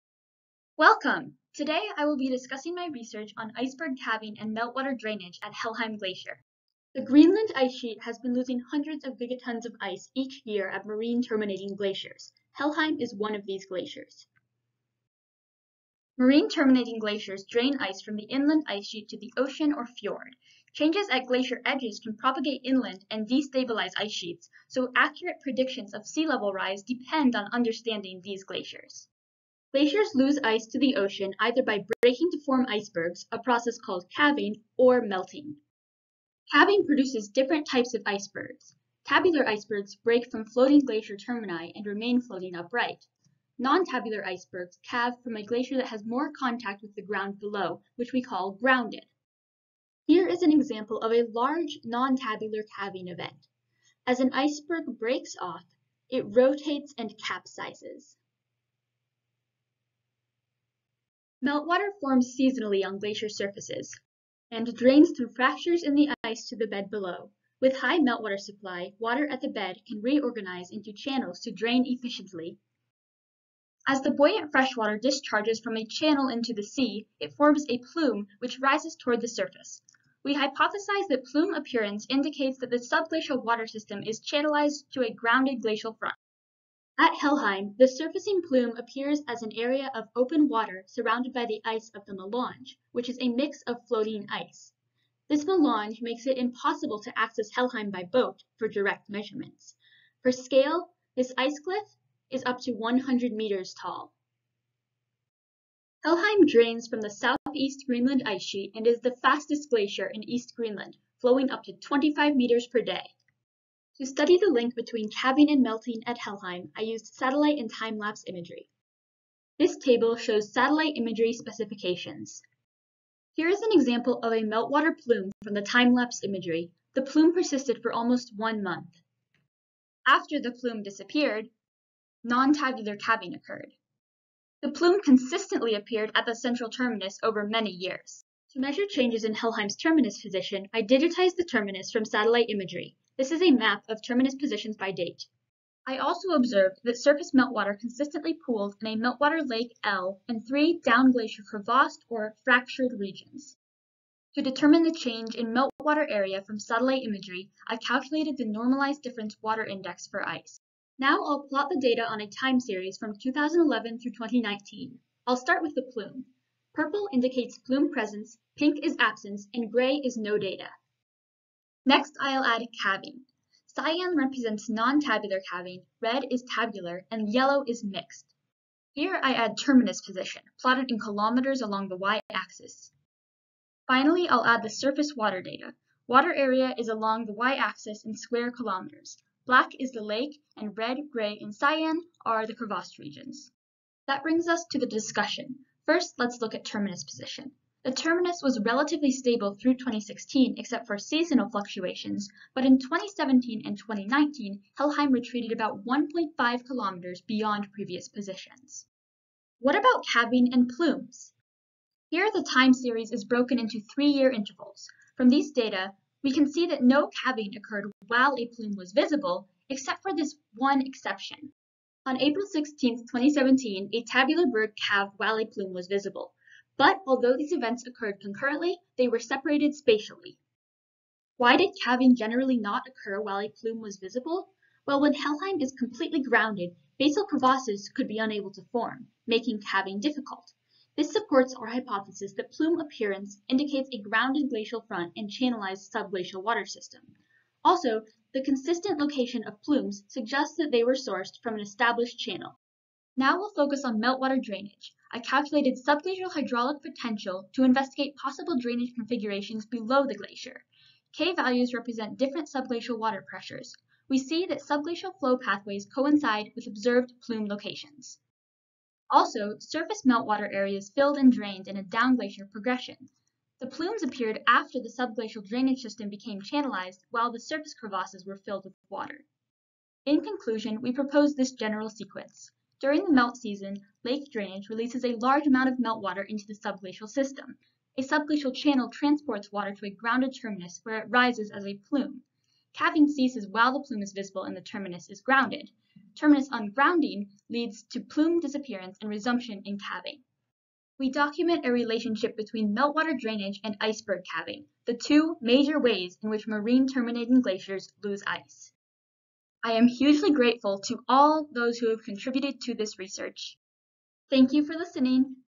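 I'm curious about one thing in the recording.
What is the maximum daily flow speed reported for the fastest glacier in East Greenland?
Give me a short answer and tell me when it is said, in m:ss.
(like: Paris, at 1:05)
25 meters per day, at 1:51.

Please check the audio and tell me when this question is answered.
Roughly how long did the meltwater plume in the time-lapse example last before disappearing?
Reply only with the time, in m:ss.
2:07.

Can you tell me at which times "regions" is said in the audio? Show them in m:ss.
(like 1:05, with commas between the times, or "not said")
2:32, 3:12.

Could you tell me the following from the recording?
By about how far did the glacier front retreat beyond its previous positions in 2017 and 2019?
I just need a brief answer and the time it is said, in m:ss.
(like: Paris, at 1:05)
1.5 kilometers, at 3:25.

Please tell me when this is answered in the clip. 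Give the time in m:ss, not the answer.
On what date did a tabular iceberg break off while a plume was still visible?
3:42.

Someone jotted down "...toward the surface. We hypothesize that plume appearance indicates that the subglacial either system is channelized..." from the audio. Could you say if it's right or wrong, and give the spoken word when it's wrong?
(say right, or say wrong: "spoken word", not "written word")
wrong: "water", not "either".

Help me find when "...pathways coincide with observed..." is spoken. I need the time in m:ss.
4:25.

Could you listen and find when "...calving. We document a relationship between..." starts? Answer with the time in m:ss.
4:59.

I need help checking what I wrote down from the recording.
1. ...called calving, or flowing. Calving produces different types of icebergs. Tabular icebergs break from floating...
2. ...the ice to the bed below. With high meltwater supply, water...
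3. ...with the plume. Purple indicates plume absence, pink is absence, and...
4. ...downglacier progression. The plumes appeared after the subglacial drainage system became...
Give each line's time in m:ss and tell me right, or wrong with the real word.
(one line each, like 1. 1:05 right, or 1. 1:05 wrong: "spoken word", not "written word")
1. 0:33 wrong: "melting", not "flowing"
2. 1:05 right
3. 2:45 wrong: "presence", not "absence"
4. 4:31 right.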